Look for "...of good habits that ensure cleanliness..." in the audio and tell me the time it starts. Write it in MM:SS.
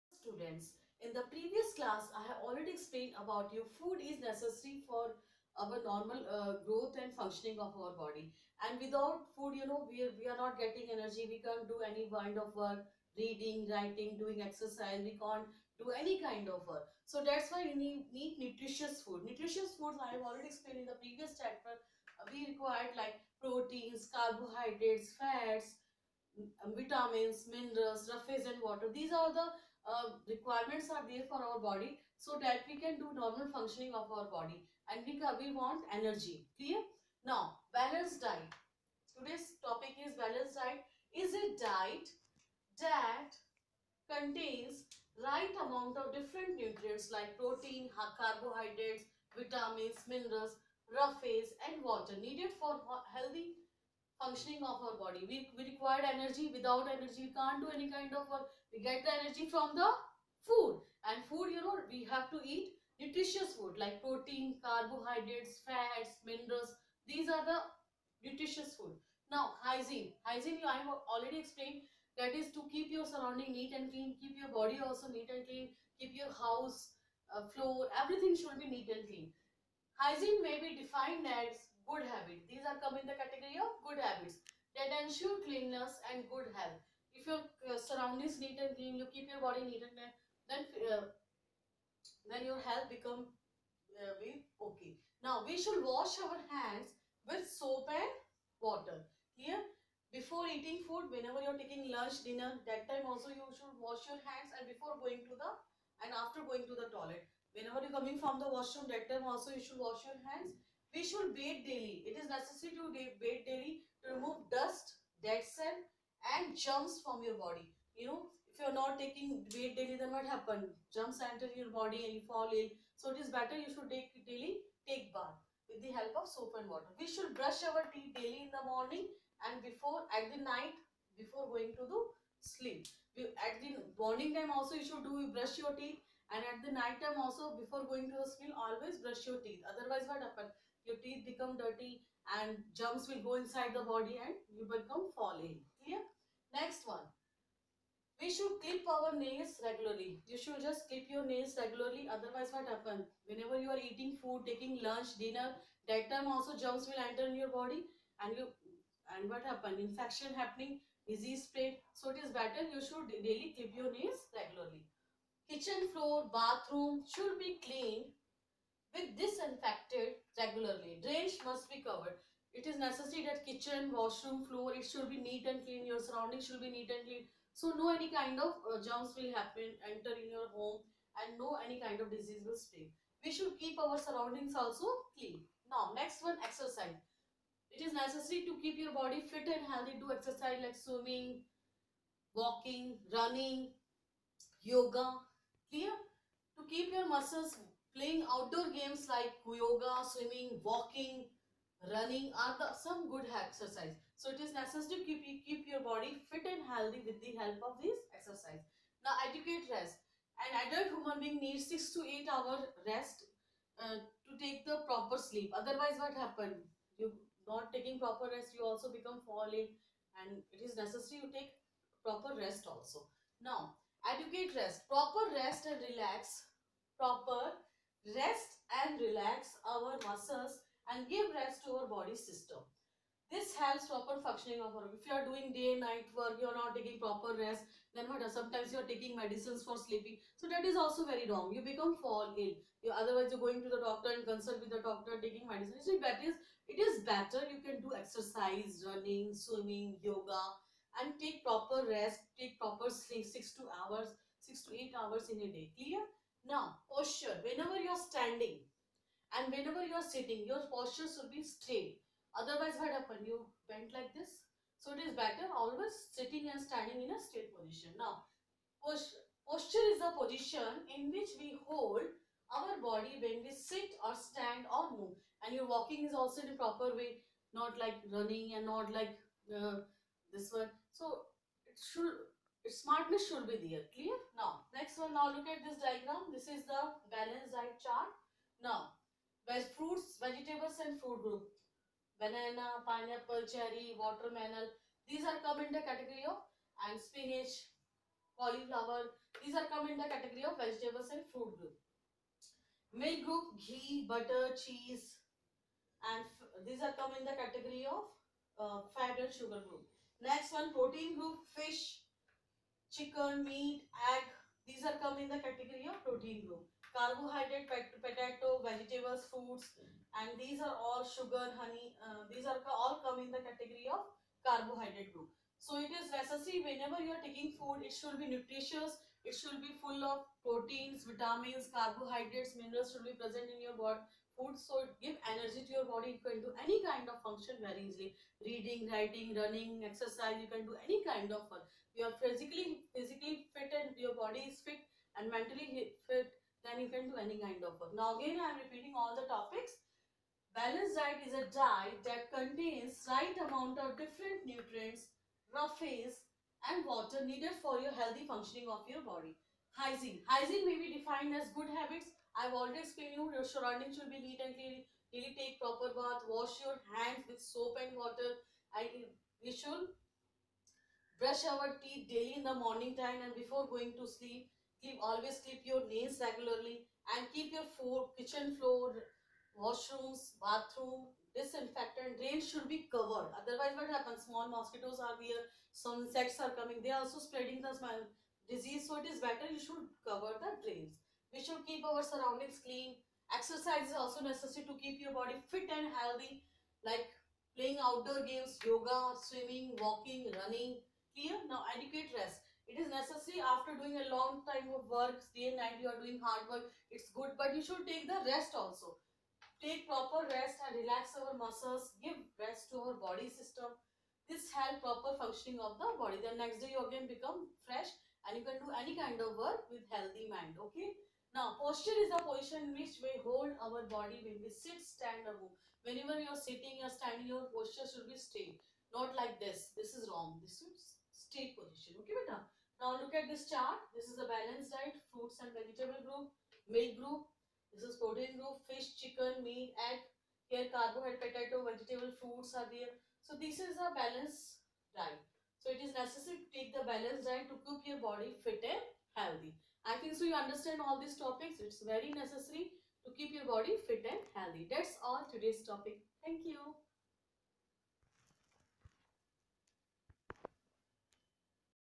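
01:23.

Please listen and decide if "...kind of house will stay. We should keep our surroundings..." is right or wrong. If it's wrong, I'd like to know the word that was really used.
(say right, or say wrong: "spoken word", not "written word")
wrong: "disease", not "house".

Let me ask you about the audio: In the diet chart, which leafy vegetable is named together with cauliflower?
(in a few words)
Spinach.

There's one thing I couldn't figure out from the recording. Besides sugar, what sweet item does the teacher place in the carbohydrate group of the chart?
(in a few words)
Honey.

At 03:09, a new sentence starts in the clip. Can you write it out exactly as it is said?
Do exercise like swimming, walking, running, yoga.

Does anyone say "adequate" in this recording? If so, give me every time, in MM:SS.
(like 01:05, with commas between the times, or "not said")
03:29, 03:44, 06:41.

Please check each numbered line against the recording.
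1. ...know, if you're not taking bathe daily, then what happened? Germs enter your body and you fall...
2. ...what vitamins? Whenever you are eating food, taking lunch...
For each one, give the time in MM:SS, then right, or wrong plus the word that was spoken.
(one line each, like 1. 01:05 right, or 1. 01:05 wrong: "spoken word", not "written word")
1. 01:58 right
2. 02:32 wrong: "happens", not "vitamins".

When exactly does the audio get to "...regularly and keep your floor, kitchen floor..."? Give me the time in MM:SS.
06:16.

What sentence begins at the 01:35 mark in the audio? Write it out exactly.
Now we should wash our hands with soap and water.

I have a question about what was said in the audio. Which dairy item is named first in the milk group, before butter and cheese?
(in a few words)
Ghee.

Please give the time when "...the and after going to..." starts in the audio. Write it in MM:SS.
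01:45.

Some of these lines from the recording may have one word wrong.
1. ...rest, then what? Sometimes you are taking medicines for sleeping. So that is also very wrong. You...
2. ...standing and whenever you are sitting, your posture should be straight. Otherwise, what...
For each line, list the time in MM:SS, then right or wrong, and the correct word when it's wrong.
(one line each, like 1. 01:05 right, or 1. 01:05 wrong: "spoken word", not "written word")
1. 03:57 right
2. 04:18 right.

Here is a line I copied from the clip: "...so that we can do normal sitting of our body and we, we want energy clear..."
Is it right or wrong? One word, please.
wrong.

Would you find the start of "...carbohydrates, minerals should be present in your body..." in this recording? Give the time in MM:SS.
05:31.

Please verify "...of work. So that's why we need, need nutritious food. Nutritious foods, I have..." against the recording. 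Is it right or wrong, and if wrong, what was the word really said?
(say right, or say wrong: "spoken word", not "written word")
right.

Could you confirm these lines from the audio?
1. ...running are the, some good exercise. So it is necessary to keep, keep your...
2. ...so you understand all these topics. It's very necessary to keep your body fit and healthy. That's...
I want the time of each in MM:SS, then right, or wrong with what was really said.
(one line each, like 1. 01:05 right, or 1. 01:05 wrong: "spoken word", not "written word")
1. 03:21 right
2. 07:30 right.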